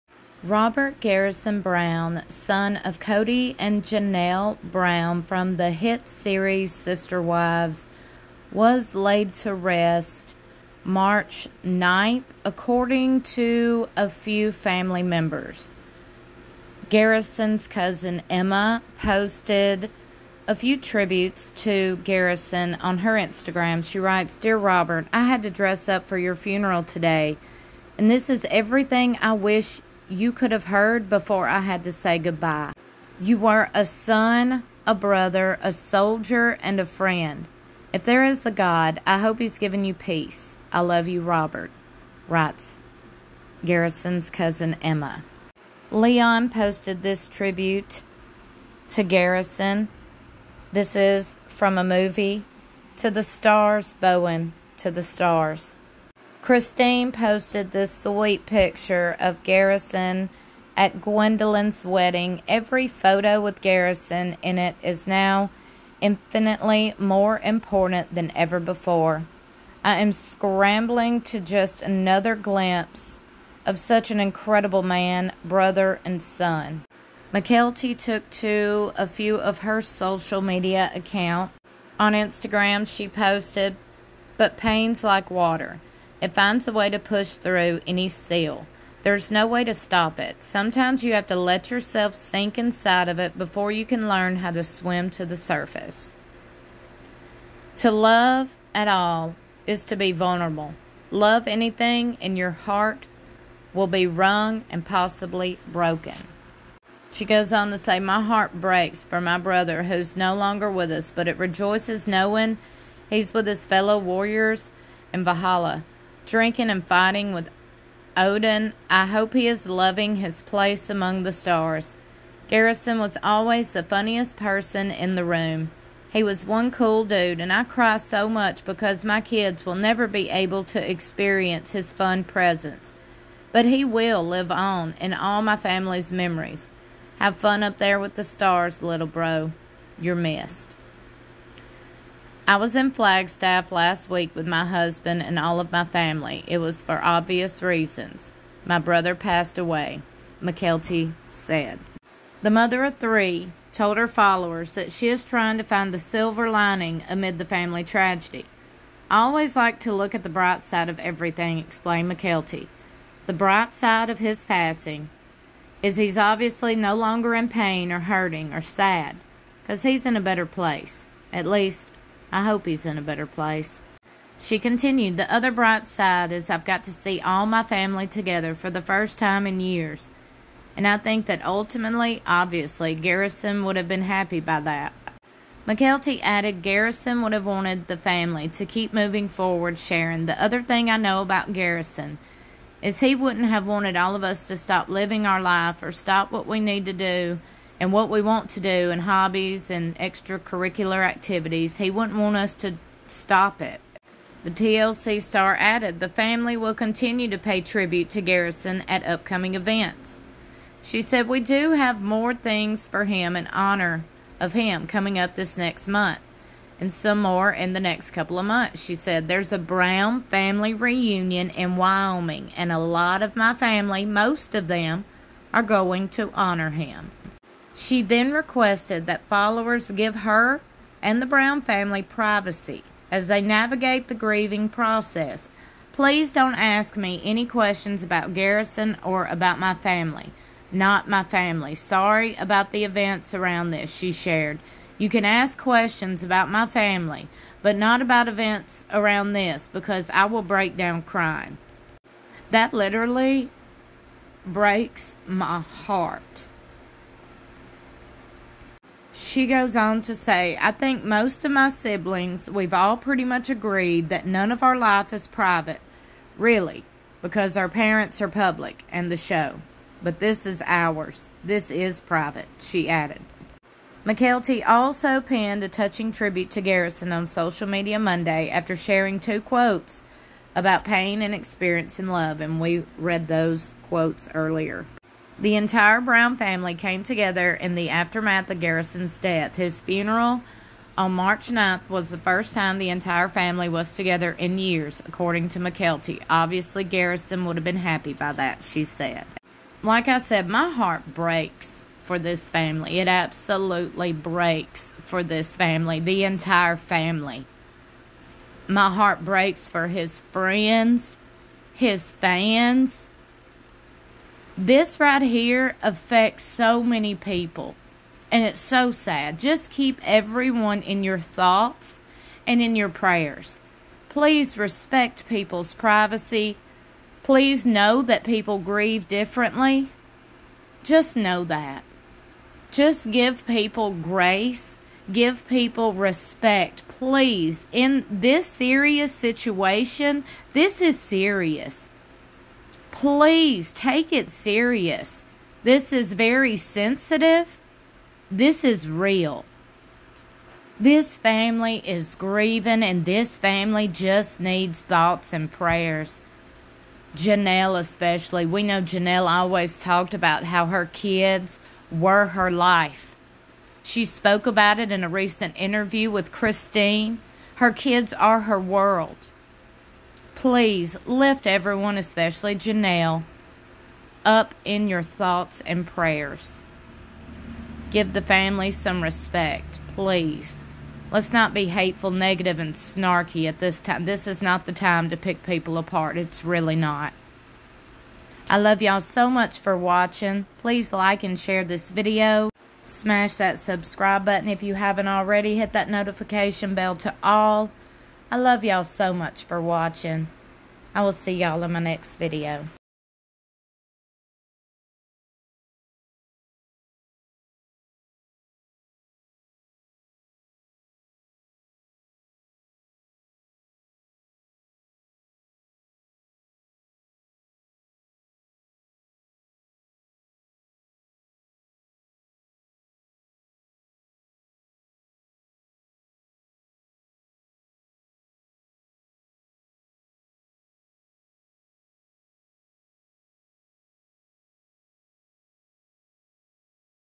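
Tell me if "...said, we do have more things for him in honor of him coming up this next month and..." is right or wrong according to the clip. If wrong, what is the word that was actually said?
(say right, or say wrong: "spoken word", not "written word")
right.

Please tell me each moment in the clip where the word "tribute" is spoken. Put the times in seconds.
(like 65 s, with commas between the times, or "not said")
20 s, 47 s, 207 s, 276 s.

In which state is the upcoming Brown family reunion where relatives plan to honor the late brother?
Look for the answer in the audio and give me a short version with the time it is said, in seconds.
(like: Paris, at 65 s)
Wyoming, at 221 s.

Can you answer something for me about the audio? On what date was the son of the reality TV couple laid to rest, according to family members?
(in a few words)
March 9th.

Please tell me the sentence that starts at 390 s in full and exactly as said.
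Please like and share this video.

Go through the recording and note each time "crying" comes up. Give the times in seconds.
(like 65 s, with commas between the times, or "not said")
251 s.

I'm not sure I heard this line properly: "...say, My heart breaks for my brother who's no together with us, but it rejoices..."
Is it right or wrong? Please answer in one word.
wrong.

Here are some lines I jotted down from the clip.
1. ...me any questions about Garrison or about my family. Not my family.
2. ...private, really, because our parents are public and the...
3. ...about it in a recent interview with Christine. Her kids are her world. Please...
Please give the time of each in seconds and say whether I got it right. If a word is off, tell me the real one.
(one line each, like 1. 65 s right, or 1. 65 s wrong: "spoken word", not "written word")
1. 236 s right
2. 265 s right
3. 364 s right.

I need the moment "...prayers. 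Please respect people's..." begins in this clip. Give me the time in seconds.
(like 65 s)
322 s.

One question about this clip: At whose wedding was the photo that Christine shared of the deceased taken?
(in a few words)
Gwendlyn's.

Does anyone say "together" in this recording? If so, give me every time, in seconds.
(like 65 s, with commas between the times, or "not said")
178 s, 287 s, 293 s.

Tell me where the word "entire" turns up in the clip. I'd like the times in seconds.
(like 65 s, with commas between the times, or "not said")
285 s, 292 s, 306 s.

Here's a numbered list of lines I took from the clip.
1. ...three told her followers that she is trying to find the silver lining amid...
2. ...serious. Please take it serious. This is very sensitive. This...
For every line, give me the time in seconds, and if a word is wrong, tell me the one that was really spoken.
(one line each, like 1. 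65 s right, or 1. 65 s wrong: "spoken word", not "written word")
1. 152 s right
2. 340 s right.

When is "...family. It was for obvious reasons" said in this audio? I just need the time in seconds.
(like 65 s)
145 s.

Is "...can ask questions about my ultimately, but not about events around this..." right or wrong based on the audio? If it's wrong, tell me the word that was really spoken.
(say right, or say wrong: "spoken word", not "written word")
wrong: "family", not "ultimately".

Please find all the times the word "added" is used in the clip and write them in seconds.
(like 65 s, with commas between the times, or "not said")
186 s, 205 s, 272 s.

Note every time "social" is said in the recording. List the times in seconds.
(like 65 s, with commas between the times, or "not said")
79 s, 277 s.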